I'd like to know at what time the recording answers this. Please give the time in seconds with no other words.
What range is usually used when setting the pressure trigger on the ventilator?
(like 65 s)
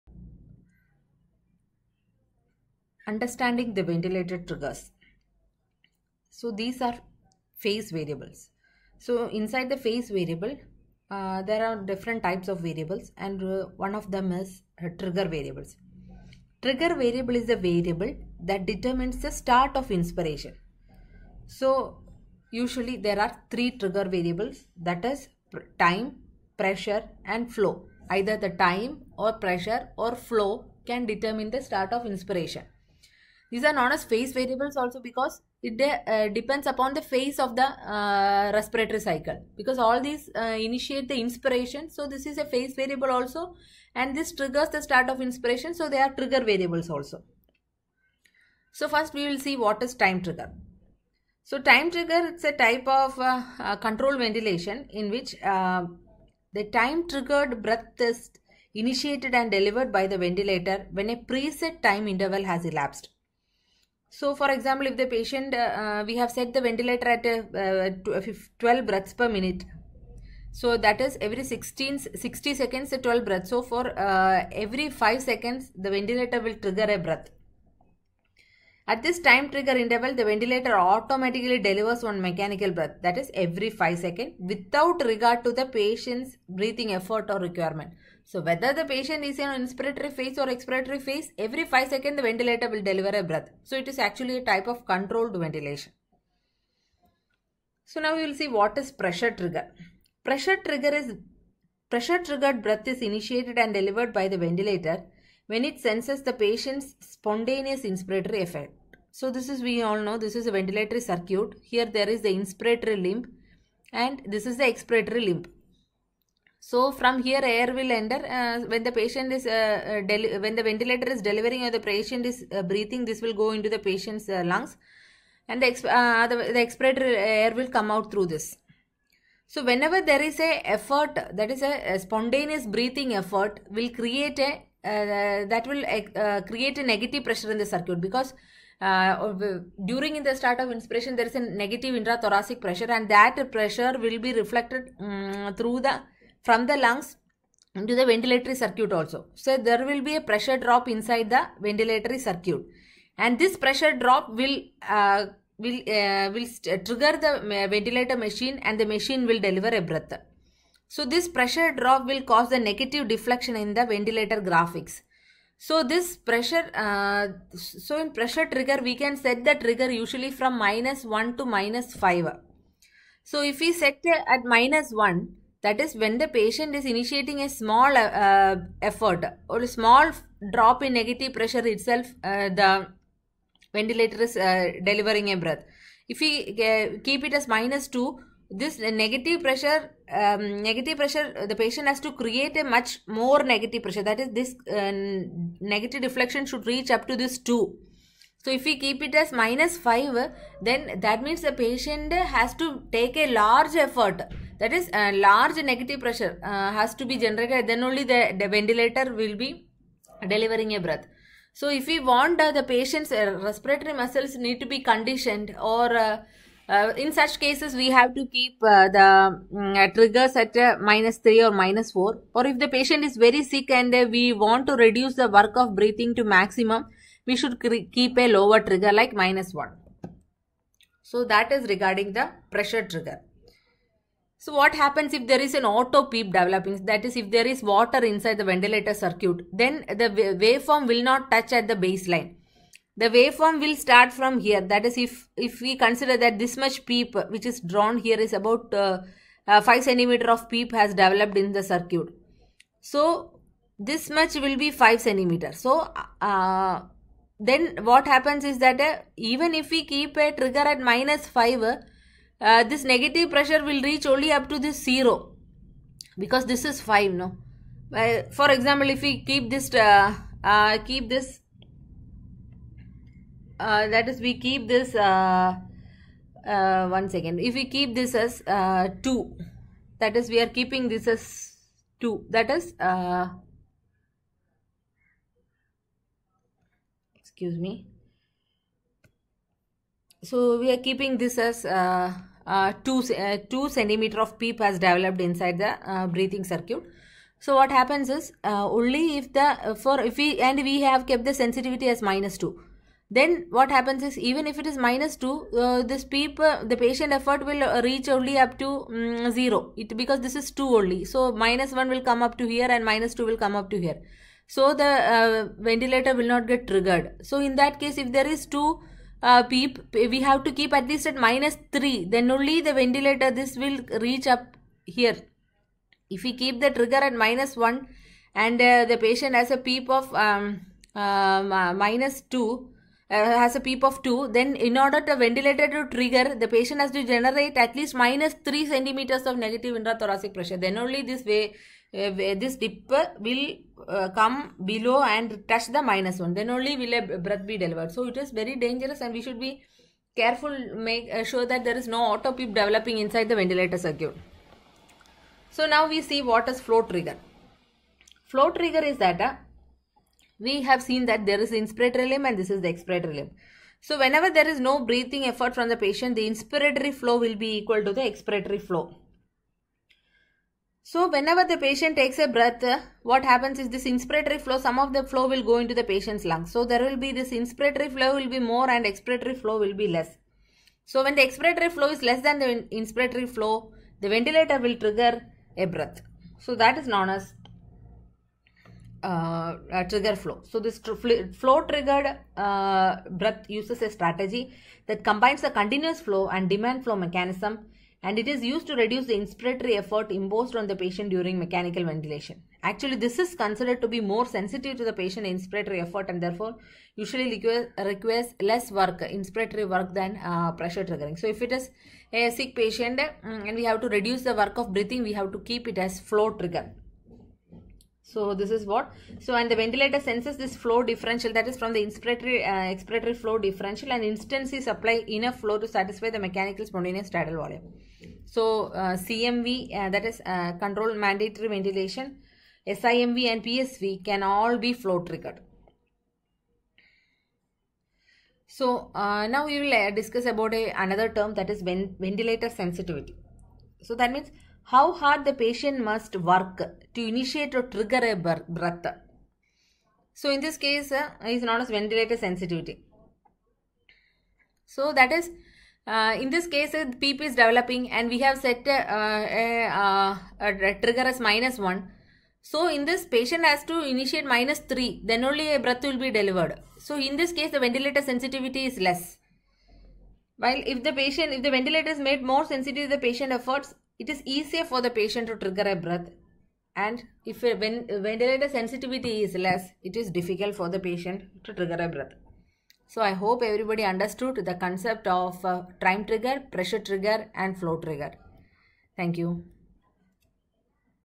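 170 s.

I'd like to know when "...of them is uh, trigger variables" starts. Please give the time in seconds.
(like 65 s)
13 s.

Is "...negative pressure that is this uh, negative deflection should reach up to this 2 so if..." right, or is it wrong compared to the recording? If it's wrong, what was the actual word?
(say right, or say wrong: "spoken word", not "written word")
right.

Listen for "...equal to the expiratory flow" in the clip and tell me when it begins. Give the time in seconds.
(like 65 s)
367 s.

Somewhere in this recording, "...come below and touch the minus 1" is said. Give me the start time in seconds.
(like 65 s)
344 s.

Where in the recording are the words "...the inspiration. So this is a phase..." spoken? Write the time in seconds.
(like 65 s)
41 s.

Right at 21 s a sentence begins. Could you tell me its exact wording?
So usually there are three trigger variables that is time, pressure and flow.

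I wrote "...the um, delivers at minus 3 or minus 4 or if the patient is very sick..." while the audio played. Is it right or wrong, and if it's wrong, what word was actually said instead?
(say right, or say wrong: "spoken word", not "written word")
wrong: "triggers", not "delivers".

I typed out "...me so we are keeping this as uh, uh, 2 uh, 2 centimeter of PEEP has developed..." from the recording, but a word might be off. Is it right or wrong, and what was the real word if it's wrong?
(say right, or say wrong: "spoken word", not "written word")
right.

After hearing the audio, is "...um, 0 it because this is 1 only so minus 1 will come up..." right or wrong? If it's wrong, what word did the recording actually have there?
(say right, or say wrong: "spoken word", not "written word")
wrong: "2", not "1".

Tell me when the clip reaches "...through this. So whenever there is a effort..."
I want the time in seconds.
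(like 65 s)
128 s.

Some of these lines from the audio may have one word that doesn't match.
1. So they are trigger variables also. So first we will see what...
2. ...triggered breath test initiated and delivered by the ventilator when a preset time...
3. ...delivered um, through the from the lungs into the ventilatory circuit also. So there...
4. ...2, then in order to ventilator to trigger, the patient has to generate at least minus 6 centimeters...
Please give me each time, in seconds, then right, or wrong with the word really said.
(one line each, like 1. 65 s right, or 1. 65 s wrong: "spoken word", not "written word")
1. 45 s right
2. 57 s right
3. 144 s wrong: "reflected", not "delivered"
4. 334 s wrong: "3", not "6".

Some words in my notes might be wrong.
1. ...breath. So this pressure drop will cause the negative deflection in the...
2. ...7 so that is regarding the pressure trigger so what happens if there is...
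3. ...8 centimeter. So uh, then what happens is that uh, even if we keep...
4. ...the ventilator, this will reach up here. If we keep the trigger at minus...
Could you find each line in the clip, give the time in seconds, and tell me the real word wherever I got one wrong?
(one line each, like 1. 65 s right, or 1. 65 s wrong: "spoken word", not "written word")
1. 159 s right
2. 229 s wrong: "1", not "7"
3. 254 s wrong: "5", not "8"
4. 322 s right.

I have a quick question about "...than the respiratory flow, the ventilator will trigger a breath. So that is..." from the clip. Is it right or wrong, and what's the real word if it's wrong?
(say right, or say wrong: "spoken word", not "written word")
wrong: "inspiratory", not "respiratory".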